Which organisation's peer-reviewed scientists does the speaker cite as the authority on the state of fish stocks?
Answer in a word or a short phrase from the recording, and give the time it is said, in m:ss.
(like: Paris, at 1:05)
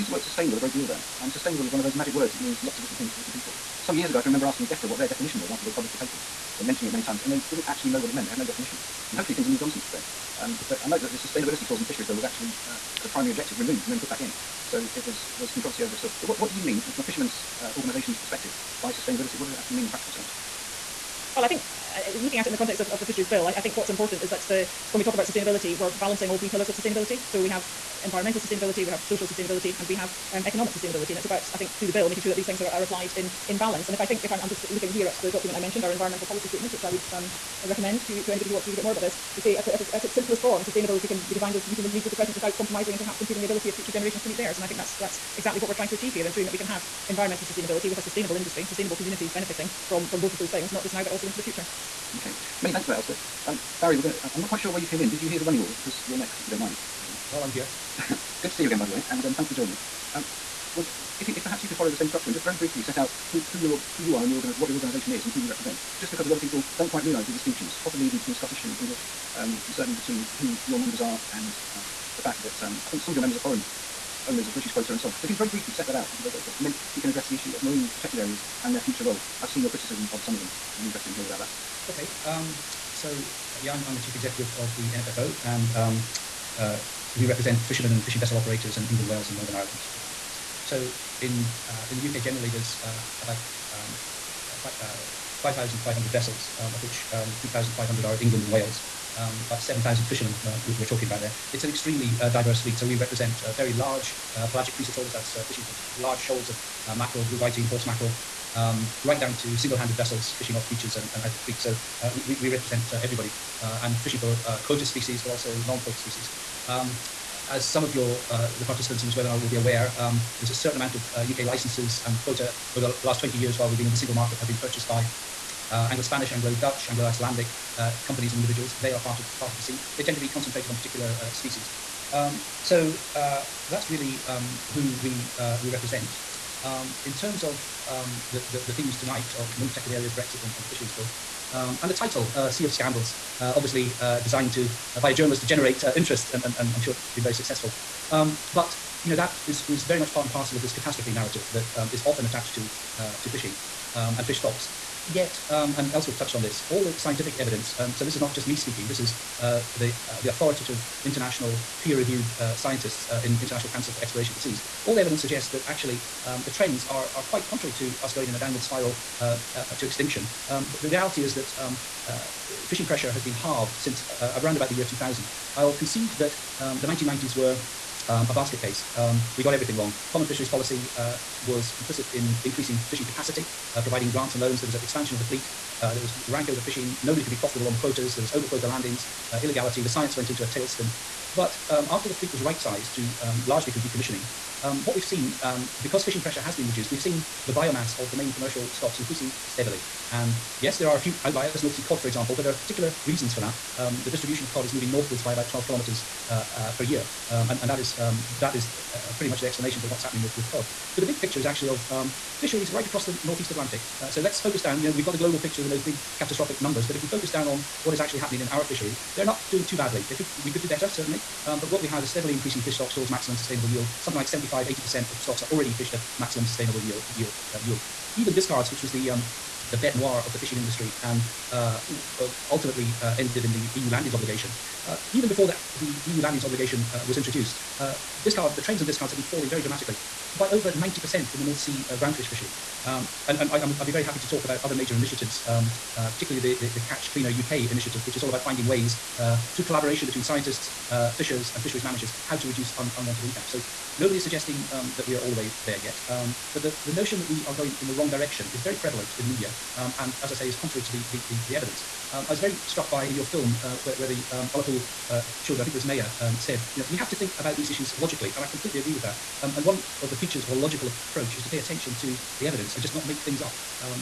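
International Council for Exploration of the Seas, at 2:43.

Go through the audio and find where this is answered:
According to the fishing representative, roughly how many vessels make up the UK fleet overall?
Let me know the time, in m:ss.
1:35.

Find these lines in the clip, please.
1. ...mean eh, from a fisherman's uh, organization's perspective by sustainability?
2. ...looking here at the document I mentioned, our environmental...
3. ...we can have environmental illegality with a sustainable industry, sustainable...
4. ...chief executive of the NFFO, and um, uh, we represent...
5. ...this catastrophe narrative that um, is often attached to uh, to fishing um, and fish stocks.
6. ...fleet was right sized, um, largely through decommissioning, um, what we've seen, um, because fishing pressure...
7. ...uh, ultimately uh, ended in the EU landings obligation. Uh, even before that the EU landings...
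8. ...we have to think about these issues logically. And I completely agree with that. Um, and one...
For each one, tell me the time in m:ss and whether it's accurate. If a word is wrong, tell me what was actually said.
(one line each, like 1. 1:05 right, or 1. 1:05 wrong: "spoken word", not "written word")
1. 0:16 right
2. 0:34 right
3. 0:46 wrong: "sustainability", not "illegality"
4. 1:23 right
5. 2:30 right
6. 3:12 right
7. 3:52 right
8. 4:26 right.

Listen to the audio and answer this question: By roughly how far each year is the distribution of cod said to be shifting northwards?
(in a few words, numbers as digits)
12 kilometers.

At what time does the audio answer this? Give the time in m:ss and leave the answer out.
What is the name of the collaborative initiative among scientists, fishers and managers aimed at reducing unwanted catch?
4:06.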